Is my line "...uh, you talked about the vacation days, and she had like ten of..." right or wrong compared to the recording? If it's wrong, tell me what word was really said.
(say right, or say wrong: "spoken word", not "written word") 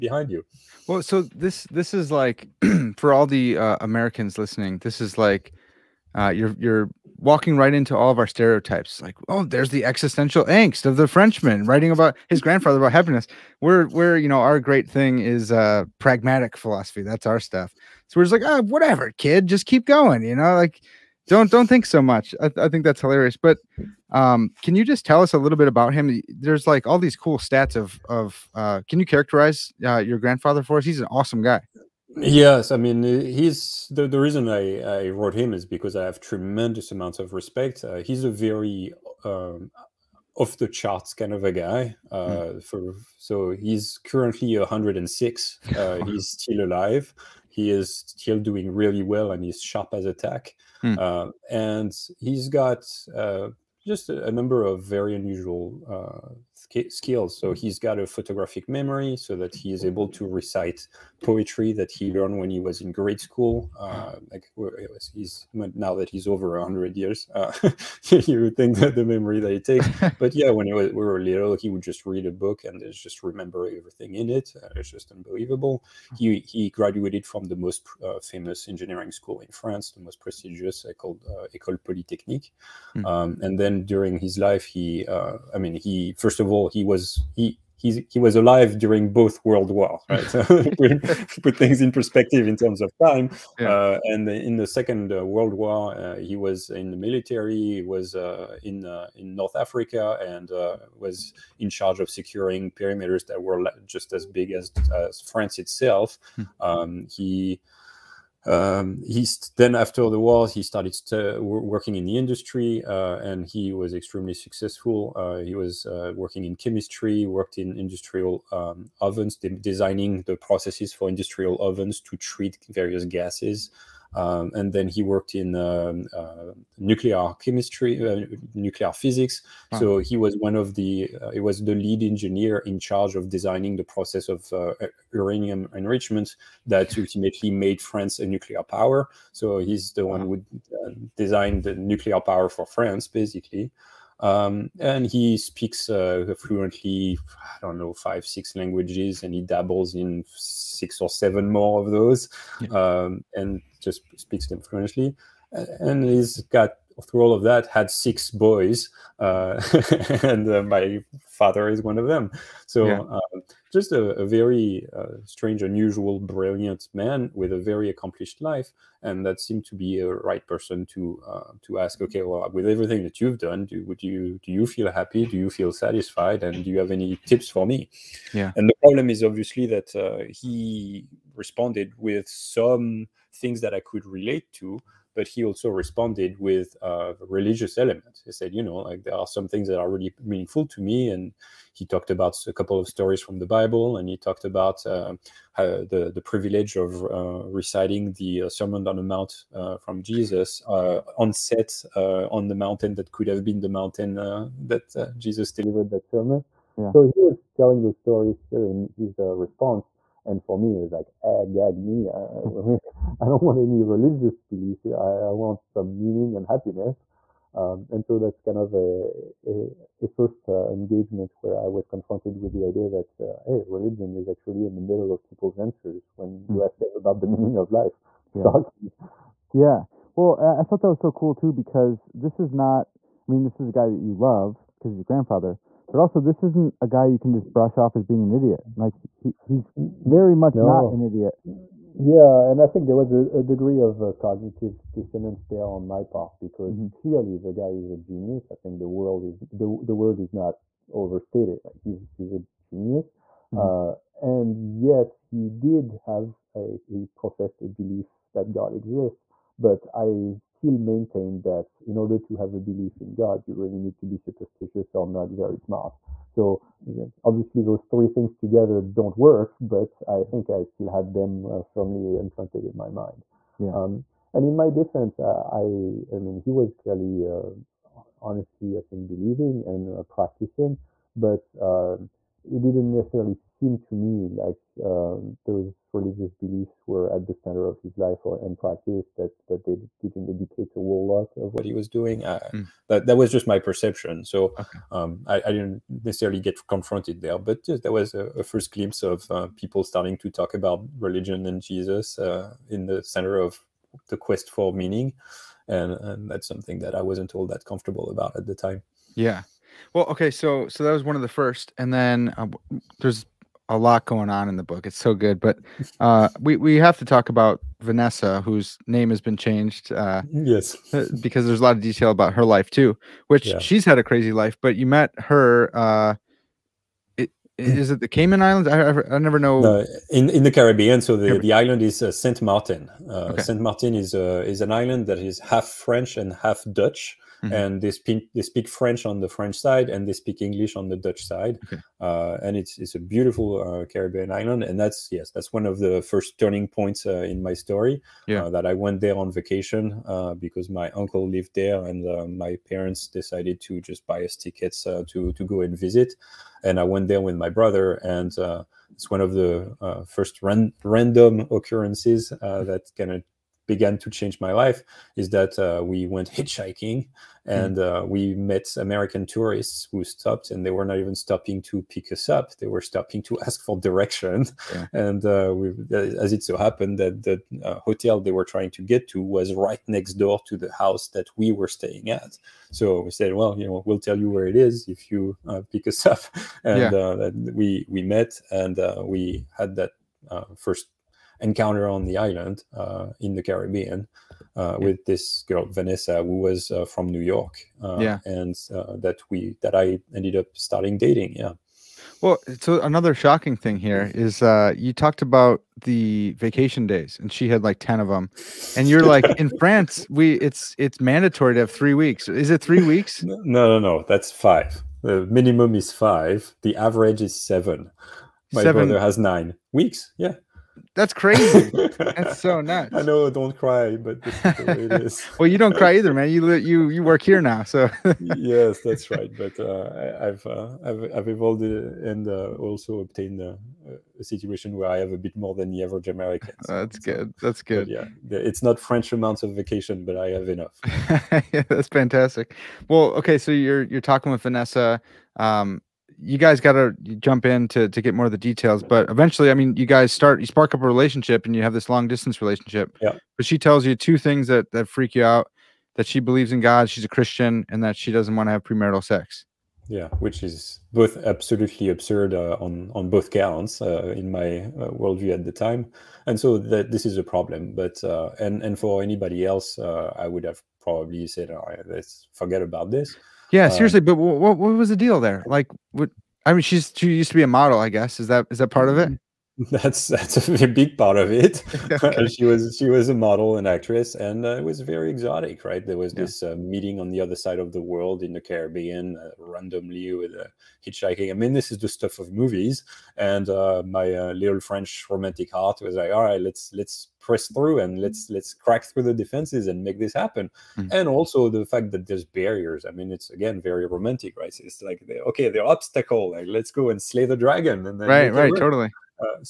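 right.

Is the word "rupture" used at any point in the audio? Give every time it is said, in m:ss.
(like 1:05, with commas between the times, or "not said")
not said.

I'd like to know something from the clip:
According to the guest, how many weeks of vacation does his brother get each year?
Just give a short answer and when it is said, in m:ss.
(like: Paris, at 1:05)
9 weeks, at 6:59.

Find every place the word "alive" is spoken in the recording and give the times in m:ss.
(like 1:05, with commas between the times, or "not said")
0:46, 1:28.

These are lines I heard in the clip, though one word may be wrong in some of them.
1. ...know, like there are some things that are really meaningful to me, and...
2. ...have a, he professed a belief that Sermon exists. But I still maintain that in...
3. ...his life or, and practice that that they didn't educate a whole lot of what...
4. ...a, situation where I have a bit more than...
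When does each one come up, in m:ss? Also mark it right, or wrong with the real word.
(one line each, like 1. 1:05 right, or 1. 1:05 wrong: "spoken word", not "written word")
1. 3:08 right
2. 4:16 wrong: "God", not "Sermon"
3. 4:47 right
4. 7:14 right.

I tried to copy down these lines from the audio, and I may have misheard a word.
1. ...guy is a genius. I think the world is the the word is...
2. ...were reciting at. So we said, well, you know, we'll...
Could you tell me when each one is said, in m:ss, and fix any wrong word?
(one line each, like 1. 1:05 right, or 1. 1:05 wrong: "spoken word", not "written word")
1. 4:07 right
2. 6:21 wrong: "staying", not "reciting".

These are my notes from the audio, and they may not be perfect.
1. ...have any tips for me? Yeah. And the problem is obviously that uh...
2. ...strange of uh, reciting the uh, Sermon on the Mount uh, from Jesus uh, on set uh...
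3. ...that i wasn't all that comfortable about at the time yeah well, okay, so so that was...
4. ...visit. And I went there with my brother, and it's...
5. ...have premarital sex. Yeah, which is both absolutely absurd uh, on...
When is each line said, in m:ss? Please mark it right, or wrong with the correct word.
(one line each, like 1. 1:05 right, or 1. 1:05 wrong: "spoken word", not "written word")
1. 2:56 right
2. 3:16 wrong: "privilege", not "strange"
3. 5:06 right
4. 5:55 right
5. 7:38 right.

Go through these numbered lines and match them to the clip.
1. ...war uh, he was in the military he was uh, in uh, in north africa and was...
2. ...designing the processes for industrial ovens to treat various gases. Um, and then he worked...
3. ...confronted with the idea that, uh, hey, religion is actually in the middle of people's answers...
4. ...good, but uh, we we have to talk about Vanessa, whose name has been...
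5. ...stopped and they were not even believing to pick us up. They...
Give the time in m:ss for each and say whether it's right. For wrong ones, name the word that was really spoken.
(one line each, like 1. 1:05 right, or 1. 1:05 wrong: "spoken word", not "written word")
1. 1:35 right
2. 1:59 right
3. 3:41 right
4. 5:15 right
5. 6:10 wrong: "stopping", not "believing".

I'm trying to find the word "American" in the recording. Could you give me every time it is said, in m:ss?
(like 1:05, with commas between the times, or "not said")
0:03, 6:08, 7:16.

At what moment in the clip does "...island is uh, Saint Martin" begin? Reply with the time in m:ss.
5:31.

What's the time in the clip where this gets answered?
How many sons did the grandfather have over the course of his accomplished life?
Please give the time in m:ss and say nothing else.
2:37.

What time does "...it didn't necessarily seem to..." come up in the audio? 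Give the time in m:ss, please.
4:42.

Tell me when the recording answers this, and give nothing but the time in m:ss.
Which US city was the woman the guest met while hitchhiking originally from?
6:37.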